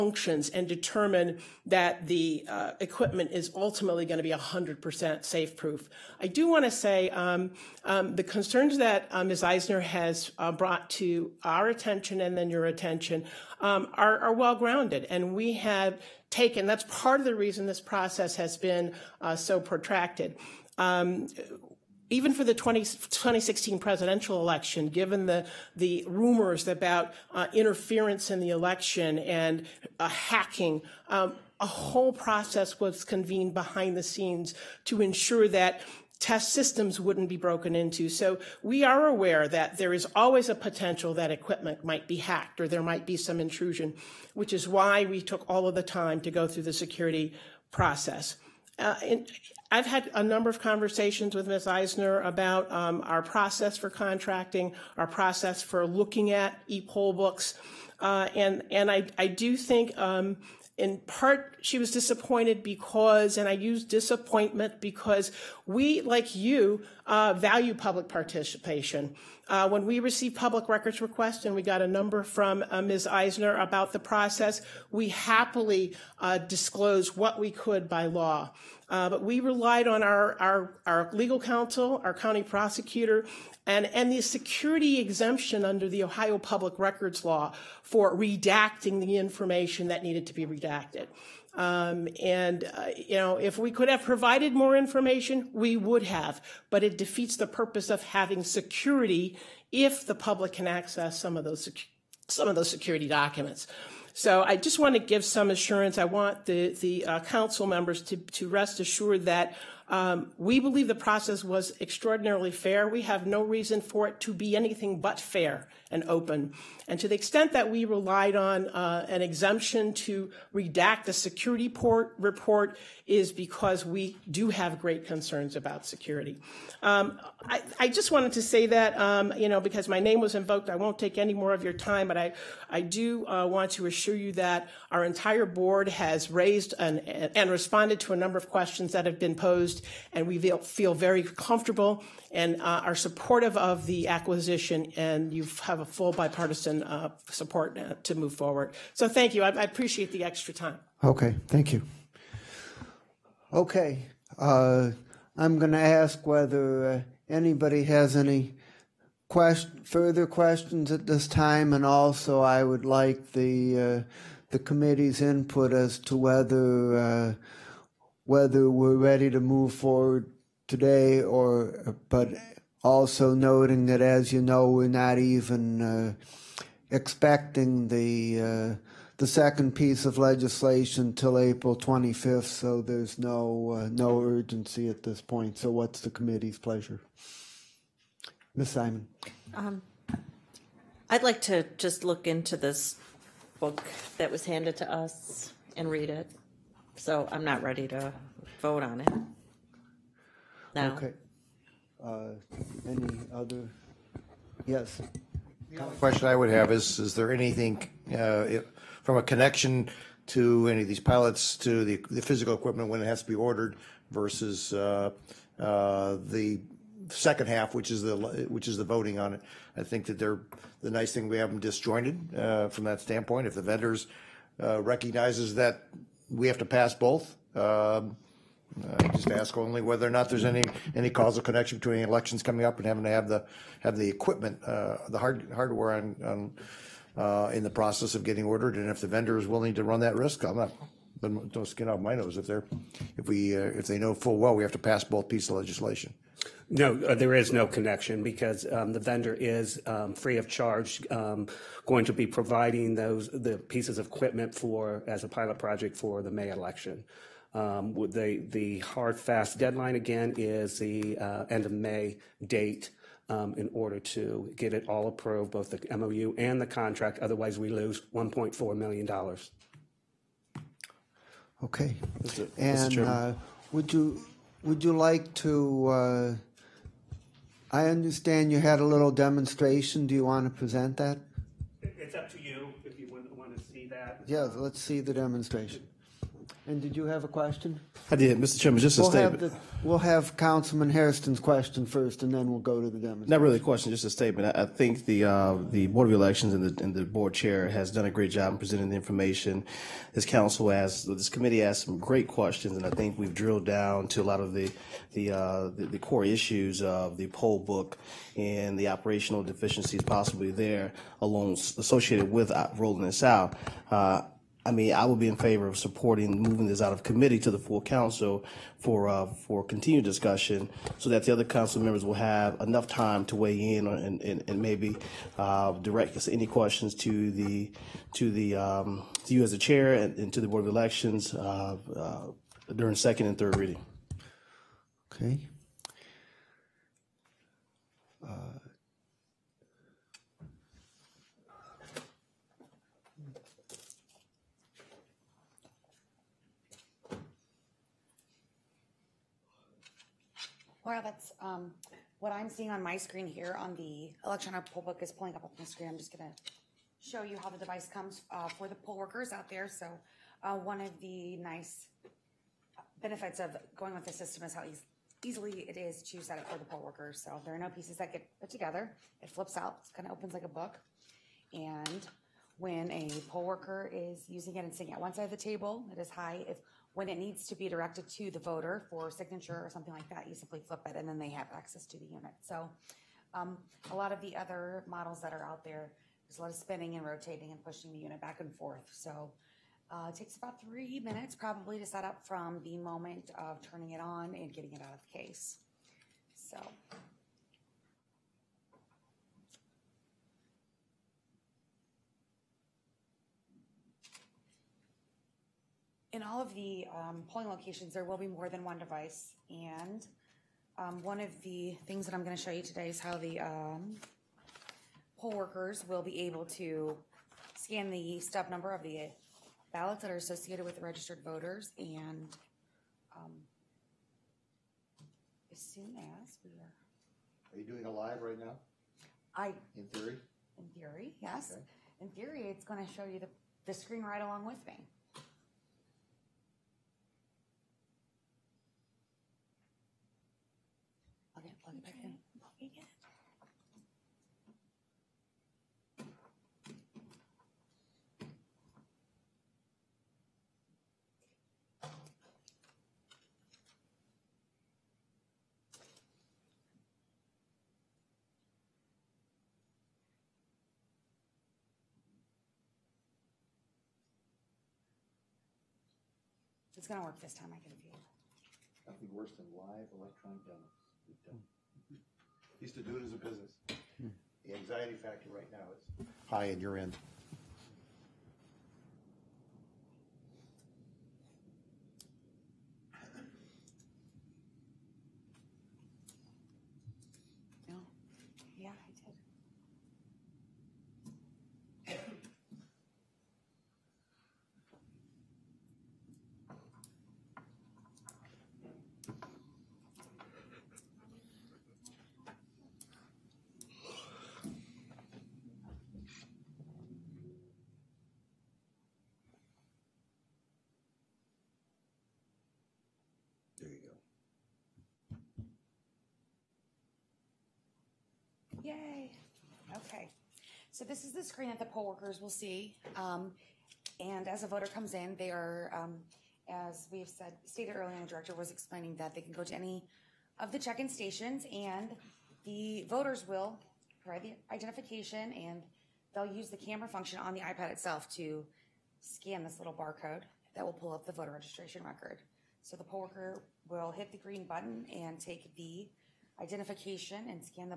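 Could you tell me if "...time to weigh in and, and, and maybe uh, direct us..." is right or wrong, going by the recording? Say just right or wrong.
right.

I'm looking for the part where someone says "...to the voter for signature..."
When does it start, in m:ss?
6:18.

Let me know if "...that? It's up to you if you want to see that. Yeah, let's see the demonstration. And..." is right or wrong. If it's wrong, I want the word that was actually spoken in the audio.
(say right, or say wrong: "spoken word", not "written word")
right.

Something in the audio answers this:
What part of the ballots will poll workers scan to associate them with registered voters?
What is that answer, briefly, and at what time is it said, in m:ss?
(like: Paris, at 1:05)
stub number, at 6:58.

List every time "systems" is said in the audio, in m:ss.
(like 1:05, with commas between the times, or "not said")
0:36, 6:04.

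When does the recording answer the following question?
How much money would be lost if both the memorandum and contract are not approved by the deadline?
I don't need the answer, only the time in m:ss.
4:28.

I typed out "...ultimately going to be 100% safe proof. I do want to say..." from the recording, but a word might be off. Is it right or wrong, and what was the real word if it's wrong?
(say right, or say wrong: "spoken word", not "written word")
right.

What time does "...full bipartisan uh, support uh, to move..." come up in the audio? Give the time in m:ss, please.
2:25.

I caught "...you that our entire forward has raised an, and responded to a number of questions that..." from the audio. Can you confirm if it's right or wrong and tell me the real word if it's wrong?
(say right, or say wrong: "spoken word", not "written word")
wrong: "board", not "forward".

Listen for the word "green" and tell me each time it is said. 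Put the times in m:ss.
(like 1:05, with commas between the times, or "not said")
9:04.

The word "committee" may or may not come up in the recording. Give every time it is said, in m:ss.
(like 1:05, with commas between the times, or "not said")
2:44, 3:06, 5:01, 5:17.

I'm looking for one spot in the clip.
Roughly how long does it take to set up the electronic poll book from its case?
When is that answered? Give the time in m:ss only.
6:30.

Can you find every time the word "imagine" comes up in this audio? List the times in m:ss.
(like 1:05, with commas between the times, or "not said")
not said.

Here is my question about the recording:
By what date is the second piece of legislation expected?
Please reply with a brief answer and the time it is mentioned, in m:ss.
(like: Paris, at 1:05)
April 25th, at 3:01.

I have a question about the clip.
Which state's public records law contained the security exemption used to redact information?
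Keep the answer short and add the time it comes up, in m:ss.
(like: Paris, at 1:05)
Ohio, at 1:26.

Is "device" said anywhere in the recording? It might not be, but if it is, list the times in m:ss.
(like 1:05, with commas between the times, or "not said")
5:57, 6:48.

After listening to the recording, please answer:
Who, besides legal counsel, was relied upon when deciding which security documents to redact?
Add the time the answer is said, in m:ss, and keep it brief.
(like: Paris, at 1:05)
county prosecutor, at 1:22.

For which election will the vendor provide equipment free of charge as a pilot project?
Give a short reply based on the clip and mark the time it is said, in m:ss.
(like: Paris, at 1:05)
May election, at 4:16.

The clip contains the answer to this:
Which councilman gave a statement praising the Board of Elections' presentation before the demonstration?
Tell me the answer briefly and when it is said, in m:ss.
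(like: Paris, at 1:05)
Hairston, at 4:50.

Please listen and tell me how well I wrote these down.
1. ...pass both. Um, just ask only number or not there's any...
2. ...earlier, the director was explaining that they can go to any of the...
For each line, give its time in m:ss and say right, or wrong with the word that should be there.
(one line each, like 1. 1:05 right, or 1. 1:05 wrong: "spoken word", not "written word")
1. 3:46 wrong: "whether", not "number"
2. 8:47 right.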